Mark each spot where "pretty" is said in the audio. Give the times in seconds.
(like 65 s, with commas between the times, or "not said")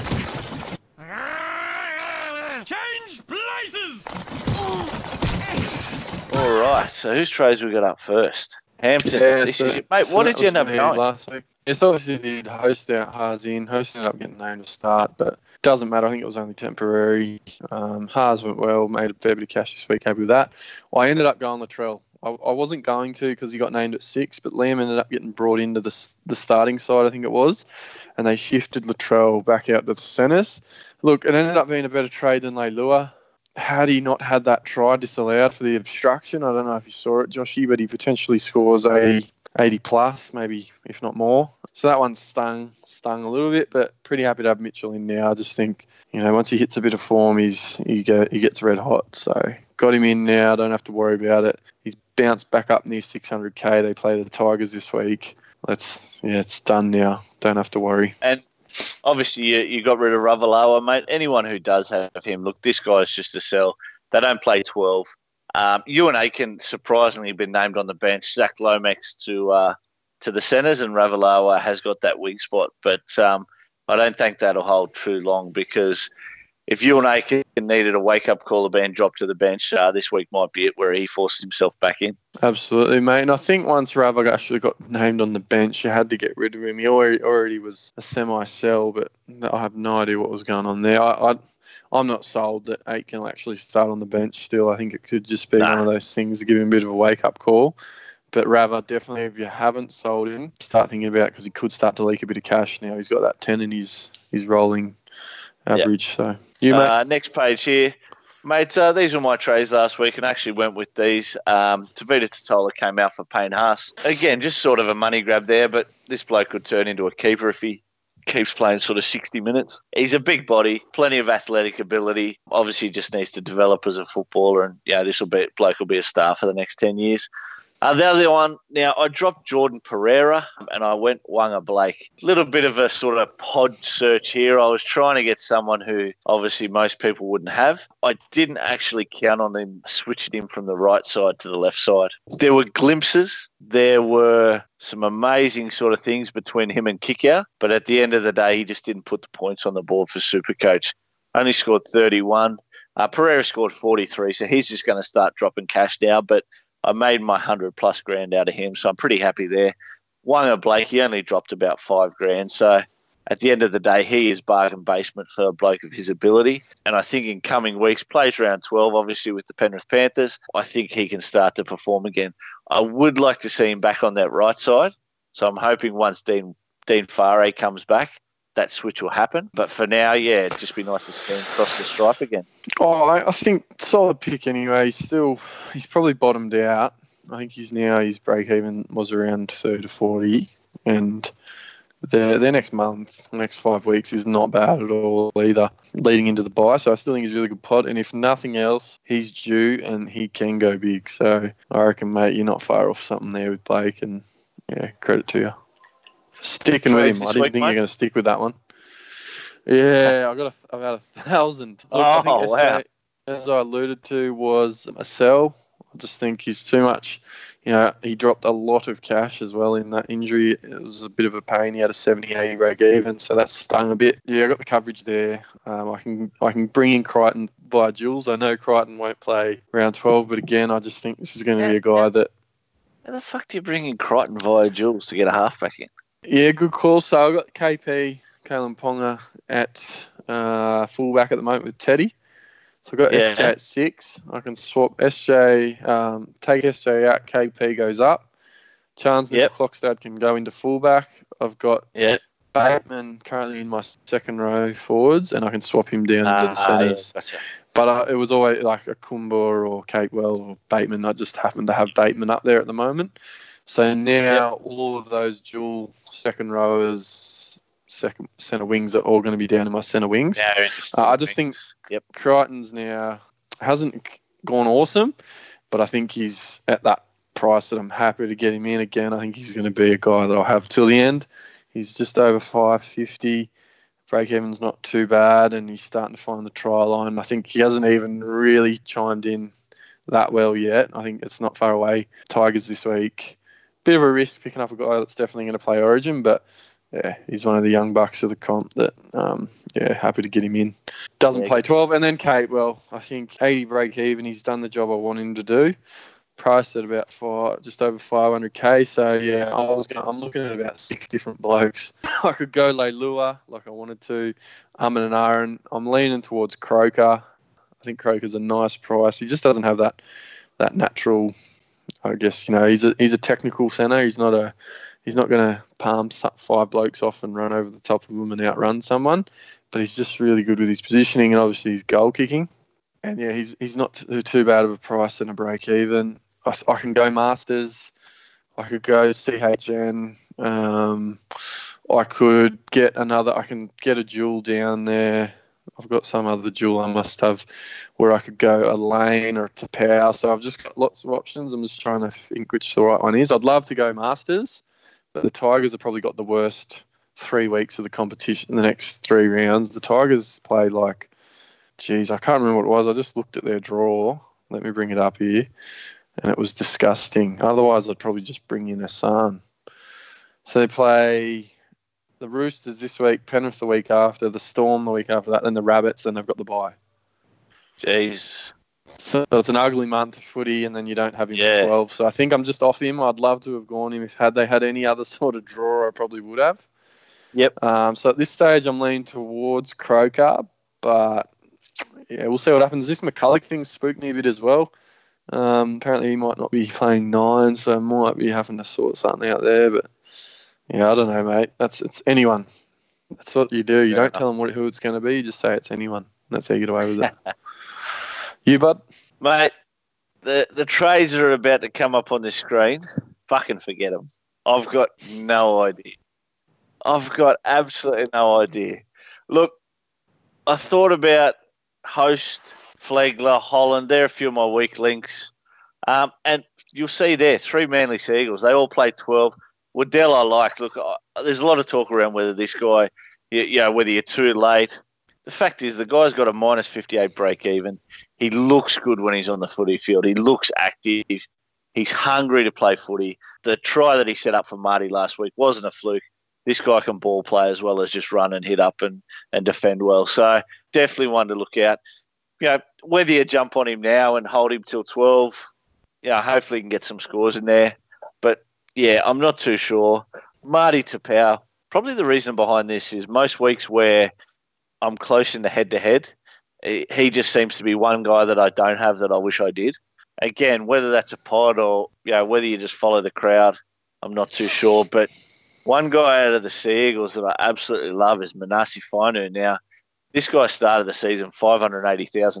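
44 s, 158 s.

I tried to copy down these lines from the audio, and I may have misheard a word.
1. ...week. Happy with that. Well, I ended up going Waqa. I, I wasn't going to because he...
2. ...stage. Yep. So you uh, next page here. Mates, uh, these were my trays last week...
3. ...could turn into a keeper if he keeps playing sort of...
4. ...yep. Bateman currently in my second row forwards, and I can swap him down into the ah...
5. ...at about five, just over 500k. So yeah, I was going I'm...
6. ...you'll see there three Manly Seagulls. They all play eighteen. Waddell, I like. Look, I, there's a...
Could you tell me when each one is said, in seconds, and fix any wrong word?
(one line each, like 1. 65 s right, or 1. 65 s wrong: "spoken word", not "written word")
1. 19 s wrong: "Latrell", not "Waqa"
2. 105 s wrong: "average", not "stage"
3. 116 s right
4. 251 s right
5. 306 s right
6. 426 s wrong: "twelve", not "eighteen".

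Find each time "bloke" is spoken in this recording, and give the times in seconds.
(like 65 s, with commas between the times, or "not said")
116 s, 125 s, 165 s, 311 s, 326 s.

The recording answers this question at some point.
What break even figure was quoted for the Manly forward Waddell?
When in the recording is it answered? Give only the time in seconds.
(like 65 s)
436 s.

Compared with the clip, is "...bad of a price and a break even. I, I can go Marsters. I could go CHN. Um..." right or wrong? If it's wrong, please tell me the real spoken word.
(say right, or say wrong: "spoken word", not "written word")
right.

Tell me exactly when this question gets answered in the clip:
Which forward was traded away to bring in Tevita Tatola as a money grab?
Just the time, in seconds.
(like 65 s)
113 s.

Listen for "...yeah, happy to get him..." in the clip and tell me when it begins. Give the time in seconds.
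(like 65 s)
299 s.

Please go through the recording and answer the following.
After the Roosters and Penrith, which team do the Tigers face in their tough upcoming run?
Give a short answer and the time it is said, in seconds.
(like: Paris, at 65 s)
the Storm, at 374 s.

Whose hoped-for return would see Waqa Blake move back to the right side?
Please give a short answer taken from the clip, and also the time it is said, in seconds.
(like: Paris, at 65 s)
Dean Whare, at 176 s.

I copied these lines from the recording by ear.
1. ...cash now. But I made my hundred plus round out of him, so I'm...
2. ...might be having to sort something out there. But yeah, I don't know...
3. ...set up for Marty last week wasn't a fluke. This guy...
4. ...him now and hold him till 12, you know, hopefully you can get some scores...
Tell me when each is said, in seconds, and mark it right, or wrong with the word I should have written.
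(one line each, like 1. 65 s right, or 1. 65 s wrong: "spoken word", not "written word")
1. 155 s wrong: "grand", not "round"
2. 397 s right
3. 444 s right
4. 453 s right.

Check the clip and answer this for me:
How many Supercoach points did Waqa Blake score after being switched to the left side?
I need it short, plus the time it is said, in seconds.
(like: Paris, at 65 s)
31, at 151 s.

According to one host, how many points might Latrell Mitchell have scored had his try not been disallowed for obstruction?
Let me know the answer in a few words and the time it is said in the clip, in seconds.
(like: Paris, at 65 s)
80 plus, at 39 s.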